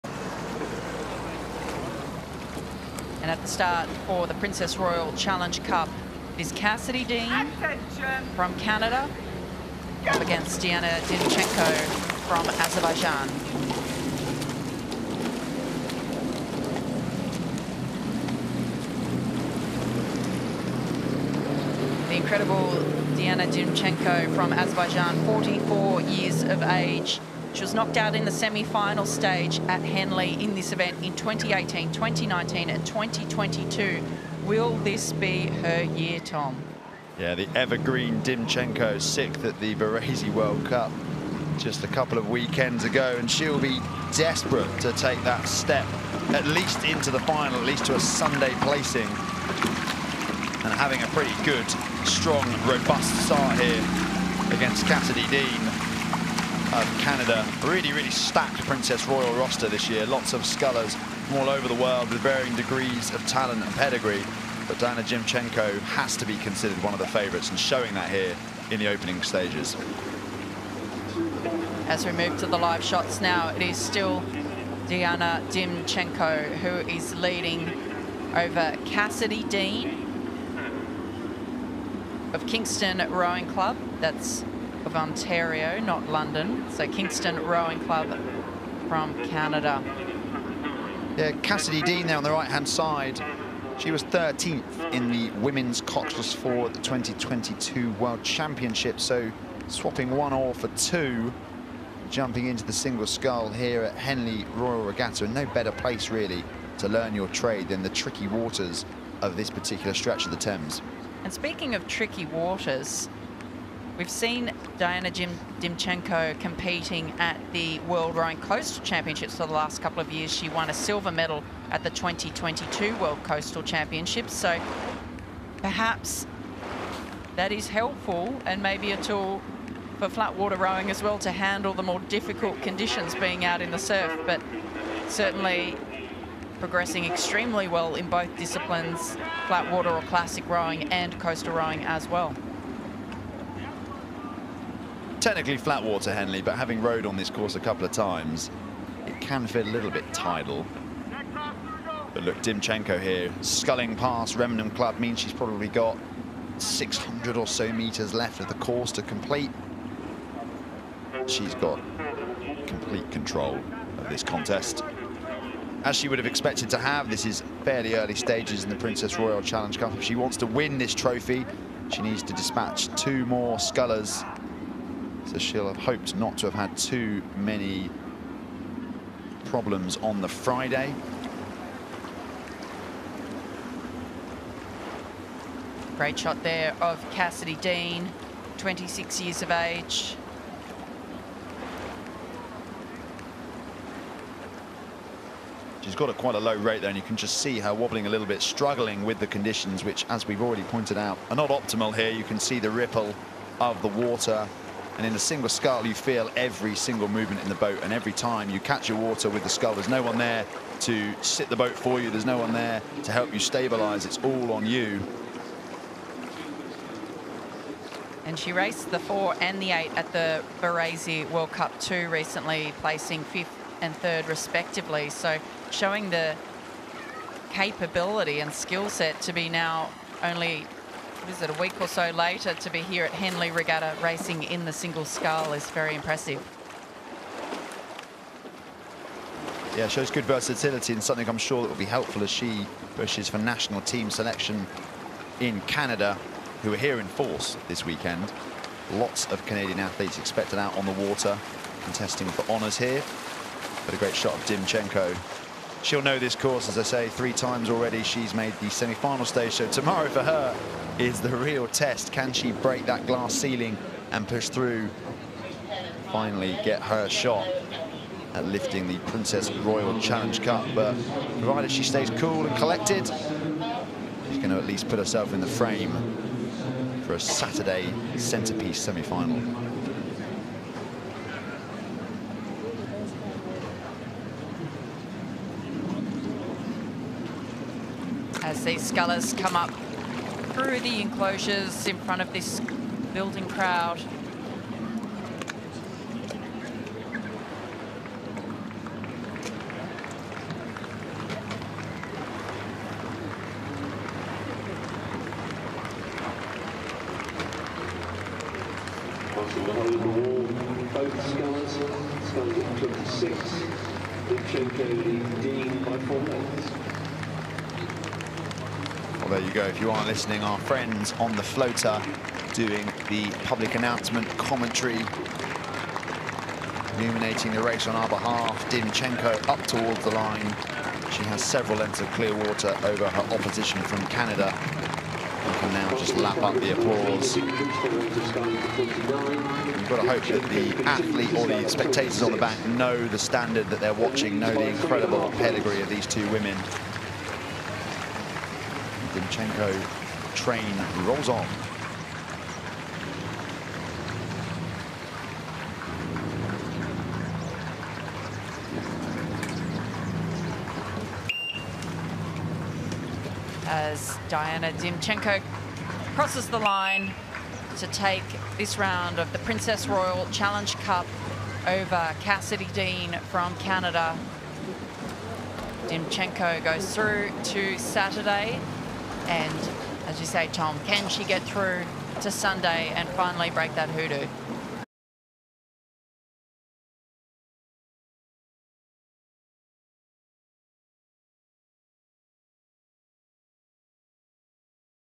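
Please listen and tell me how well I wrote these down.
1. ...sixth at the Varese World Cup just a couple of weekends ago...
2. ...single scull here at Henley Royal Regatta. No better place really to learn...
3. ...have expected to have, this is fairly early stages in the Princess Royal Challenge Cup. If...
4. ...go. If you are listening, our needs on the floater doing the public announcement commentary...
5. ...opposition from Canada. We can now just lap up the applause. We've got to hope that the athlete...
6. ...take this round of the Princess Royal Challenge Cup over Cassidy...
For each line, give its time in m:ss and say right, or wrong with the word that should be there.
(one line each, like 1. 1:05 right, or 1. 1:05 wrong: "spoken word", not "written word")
1. 0:39 right
2. 1:42 right
3. 2:46 right
4. 5:19 wrong: "friends", not "needs"
5. 5:33 right
6. 6:07 right.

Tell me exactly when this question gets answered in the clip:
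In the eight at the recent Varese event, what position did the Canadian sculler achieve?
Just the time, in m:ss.
3:43.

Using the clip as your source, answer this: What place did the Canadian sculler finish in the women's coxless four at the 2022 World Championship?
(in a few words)
13th.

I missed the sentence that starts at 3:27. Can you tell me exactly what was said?
And every time you catch your water with the scull, there's no one there to sit the boat for you.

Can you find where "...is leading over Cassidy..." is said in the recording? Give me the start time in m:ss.
1:16.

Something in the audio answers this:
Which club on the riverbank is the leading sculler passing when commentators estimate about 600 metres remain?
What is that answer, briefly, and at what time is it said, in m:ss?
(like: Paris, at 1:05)
Remenham Club, at 2:34.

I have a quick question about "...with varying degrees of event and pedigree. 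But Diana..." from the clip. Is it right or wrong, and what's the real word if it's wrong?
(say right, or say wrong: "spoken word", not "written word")
wrong: "talent", not "event".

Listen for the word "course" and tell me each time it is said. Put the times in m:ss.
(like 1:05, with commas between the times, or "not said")
2:27, 2:38, 4:16.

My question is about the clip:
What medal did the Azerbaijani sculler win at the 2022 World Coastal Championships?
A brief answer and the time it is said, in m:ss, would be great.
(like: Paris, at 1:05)
Silver, at 2:00.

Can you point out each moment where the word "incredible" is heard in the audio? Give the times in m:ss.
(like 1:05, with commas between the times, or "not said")
0:22, 5:44.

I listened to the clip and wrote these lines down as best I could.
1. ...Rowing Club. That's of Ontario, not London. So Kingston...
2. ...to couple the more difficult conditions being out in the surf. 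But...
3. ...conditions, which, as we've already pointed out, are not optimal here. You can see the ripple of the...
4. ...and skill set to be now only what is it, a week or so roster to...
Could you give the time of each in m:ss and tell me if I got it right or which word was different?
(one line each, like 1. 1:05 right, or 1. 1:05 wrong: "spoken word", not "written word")
1. 1:23 right
2. 2:11 wrong: "handle", not "couple"
3. 3:19 right
4. 3:48 wrong: "later", not "roster".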